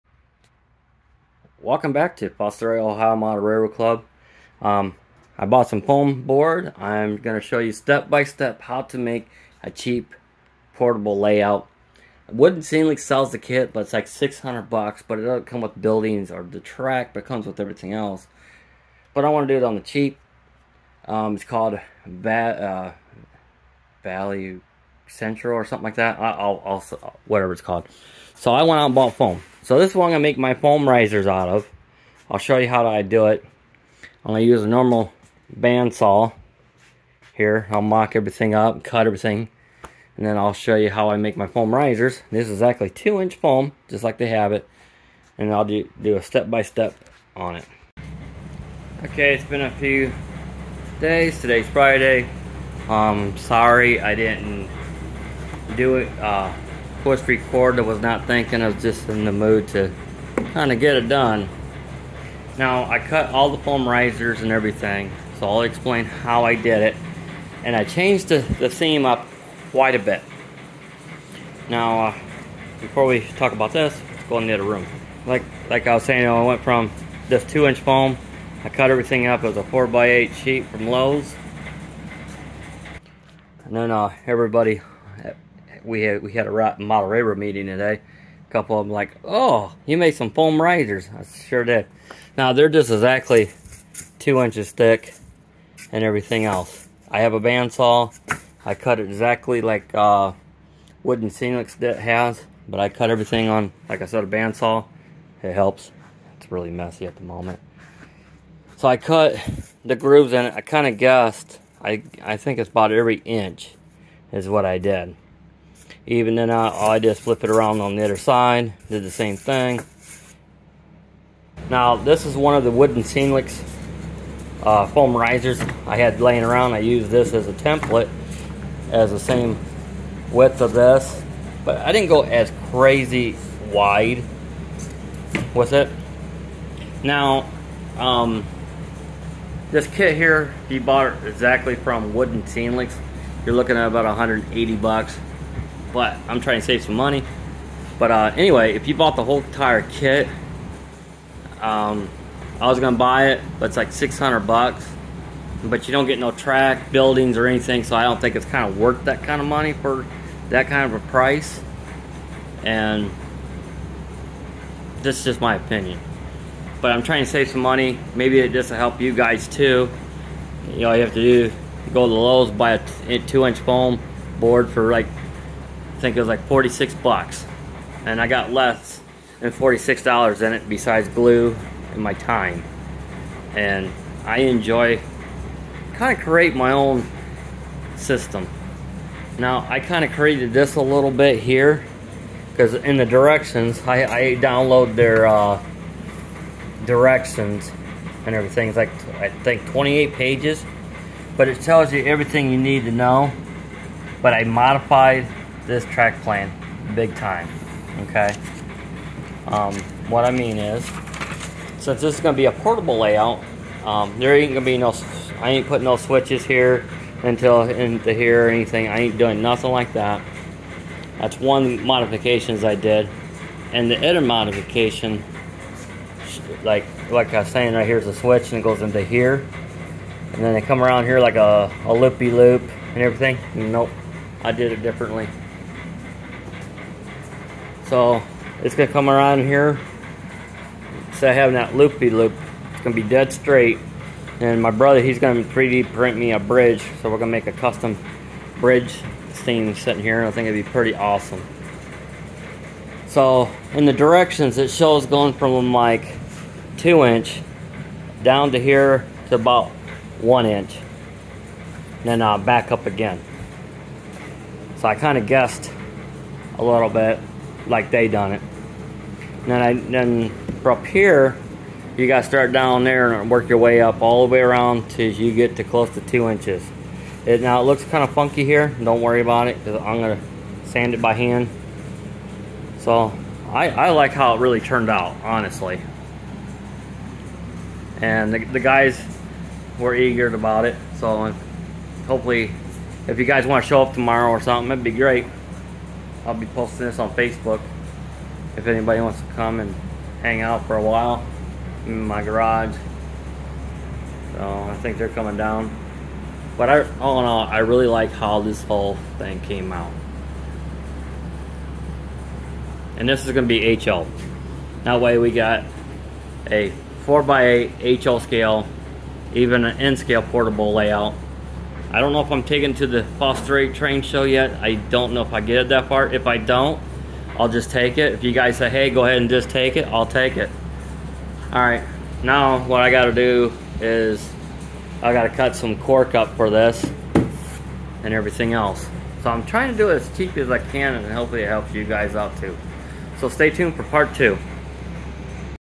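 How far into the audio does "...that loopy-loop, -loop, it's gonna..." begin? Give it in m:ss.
4:01.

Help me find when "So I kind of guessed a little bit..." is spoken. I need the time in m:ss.
4:24.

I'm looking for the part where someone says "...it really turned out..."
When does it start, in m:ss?
4:44.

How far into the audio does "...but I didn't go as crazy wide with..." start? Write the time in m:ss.
2:11.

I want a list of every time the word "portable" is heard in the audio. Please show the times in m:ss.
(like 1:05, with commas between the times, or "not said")
0:10, 3:32, 5:20.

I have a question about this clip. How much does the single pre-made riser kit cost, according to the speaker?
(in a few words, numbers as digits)
$180.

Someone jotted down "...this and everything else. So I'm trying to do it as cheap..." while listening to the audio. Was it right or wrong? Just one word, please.
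right.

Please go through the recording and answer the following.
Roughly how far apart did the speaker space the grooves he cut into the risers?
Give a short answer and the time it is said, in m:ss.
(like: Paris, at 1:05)
every inch, at 1:52.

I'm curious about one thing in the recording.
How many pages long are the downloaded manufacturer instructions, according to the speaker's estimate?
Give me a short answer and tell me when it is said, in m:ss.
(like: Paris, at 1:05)
28, at 3:19.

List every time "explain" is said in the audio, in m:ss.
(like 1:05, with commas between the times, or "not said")
1:05.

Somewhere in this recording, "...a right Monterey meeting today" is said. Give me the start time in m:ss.
1:26.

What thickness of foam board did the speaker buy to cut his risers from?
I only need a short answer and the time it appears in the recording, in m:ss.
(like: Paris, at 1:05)
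2 inch, at 0:42.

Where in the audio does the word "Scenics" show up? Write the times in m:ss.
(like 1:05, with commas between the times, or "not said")
0:12, 2:03, 2:22.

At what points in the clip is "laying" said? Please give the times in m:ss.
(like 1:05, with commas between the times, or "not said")
2:06.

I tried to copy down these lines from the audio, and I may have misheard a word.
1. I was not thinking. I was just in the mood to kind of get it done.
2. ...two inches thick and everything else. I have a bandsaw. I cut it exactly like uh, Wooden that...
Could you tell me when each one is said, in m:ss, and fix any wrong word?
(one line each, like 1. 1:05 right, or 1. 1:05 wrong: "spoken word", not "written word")
1. 0:57 right
2. 1:34 right.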